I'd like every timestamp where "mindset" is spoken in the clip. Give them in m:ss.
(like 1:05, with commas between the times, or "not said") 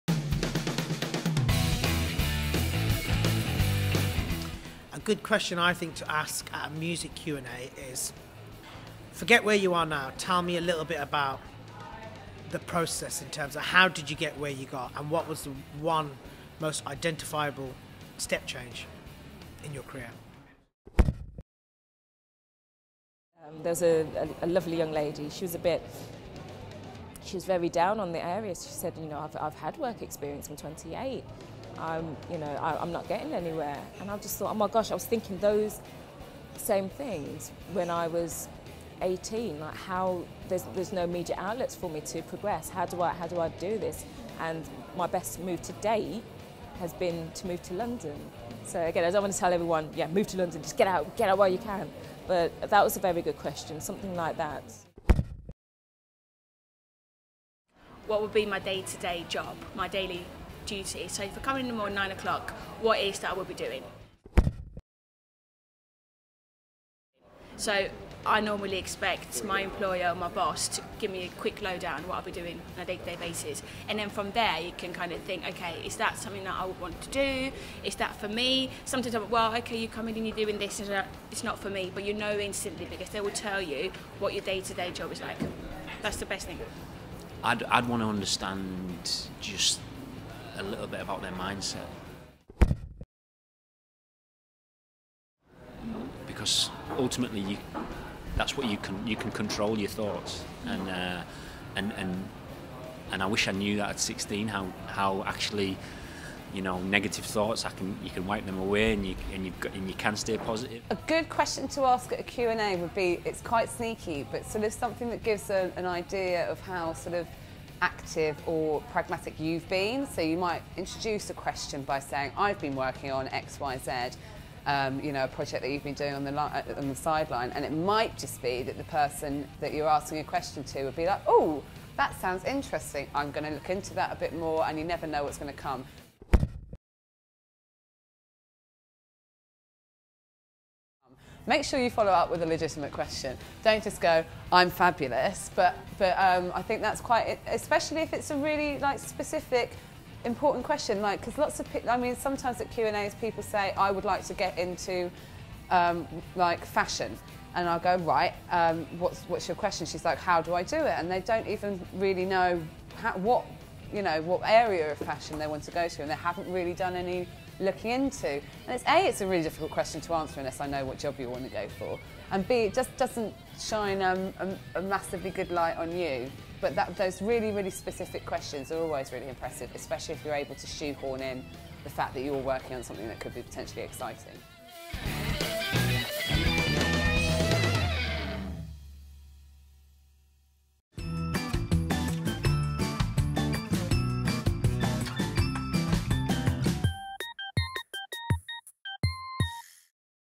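1:31.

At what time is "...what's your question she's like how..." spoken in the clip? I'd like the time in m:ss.
2:39.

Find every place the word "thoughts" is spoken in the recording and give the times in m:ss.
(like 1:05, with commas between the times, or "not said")
0:34, 1:39, 1:47.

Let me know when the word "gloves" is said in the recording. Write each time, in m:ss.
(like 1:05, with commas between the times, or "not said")
not said.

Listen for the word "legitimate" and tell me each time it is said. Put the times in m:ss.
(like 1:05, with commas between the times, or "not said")
2:22.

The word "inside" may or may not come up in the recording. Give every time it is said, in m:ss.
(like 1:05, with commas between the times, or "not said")
not said.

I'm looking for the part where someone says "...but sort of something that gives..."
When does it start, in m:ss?
1:54.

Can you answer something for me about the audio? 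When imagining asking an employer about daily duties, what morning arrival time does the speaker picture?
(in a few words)
9 o'clock.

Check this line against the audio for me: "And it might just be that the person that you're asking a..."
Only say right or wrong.
right.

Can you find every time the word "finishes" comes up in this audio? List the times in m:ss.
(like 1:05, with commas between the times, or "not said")
not said.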